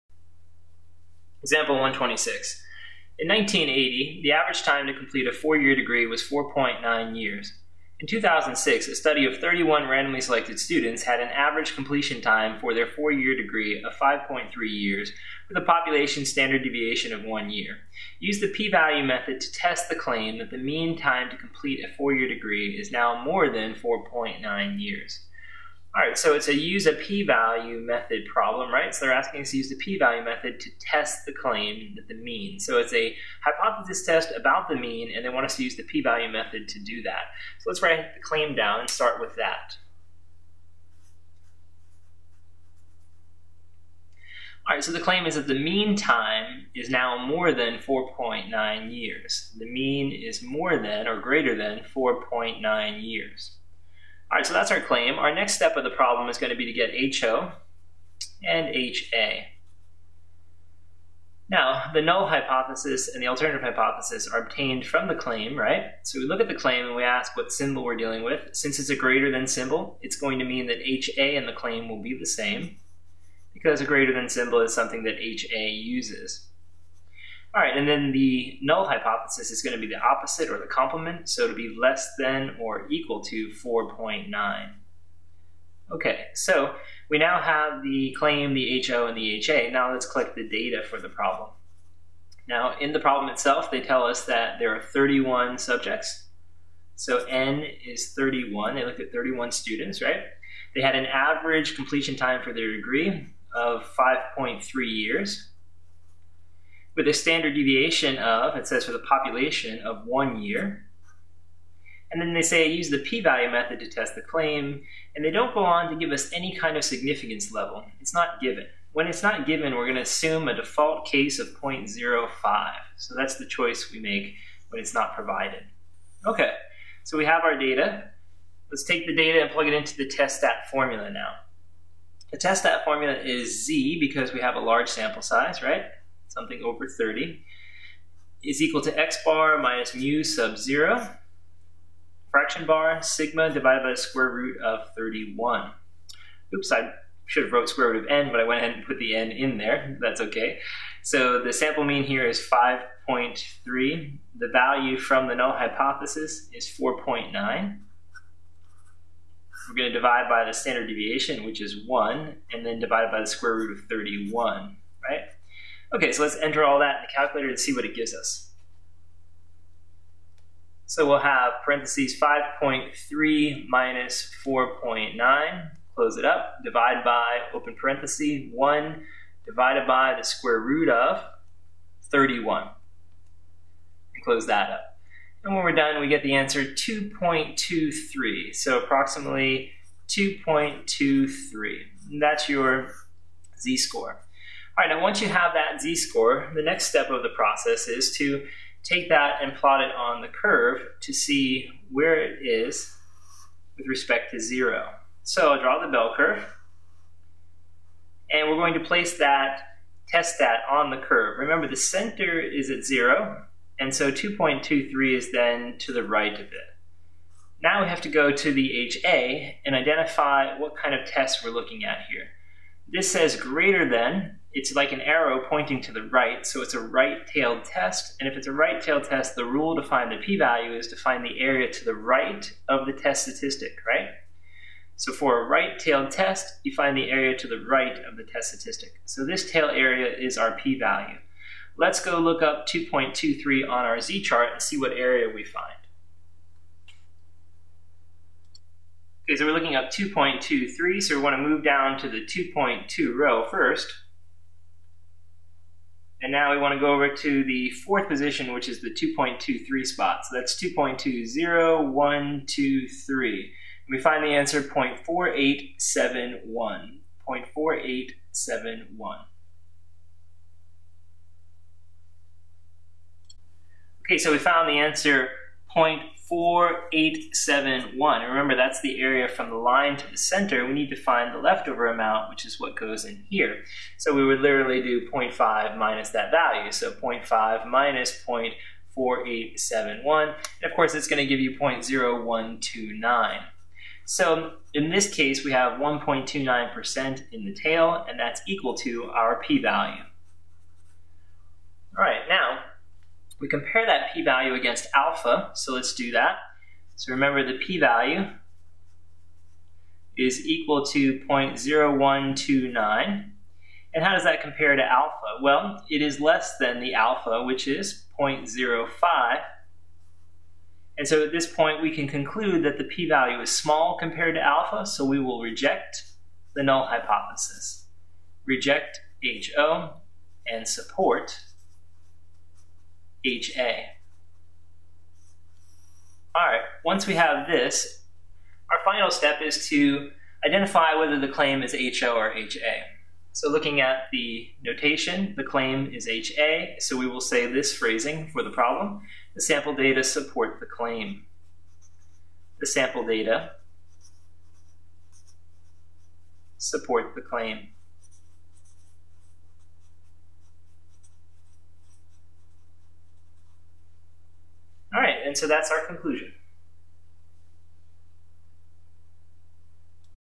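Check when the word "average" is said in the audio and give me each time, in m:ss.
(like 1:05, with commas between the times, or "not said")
0:04, 0:11, 1:41.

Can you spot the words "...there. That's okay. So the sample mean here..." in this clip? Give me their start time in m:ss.
2:29.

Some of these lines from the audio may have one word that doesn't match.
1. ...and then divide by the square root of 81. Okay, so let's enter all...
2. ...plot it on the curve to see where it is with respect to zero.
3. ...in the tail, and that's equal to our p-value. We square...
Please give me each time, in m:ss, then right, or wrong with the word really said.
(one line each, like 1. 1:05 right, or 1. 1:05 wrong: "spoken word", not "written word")
1. 2:42 wrong: "31", not "81"
2. 3:19 right
3. 4:57 wrong: "compare", not "square".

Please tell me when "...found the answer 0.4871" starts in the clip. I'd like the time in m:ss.
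4:34.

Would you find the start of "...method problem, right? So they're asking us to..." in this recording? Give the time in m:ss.
0:27.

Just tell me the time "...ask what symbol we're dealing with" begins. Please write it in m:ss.
1:07.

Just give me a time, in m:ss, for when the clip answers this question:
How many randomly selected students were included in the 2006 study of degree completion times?
0:09.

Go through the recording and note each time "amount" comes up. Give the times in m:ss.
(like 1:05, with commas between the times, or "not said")
4:41.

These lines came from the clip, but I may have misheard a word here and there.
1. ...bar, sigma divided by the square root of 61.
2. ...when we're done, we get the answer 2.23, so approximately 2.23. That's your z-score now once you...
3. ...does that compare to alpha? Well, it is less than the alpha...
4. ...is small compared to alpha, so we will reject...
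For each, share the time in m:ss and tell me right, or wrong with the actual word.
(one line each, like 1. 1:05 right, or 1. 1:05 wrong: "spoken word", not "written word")
1. 2:22 wrong: "31", not "61"
2. 3:05 right
3. 5:14 right
4. 5:23 right.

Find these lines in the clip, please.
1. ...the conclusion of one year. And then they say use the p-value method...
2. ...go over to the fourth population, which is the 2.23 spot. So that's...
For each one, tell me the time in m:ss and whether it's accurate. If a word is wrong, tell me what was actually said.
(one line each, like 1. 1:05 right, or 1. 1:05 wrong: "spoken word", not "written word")
1. 1:48 wrong: "population", not "conclusion"
2. 4:16 wrong: "position", not "population".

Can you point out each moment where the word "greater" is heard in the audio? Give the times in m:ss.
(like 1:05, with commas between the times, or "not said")
0:51, 1:08, 1:13, 3:43.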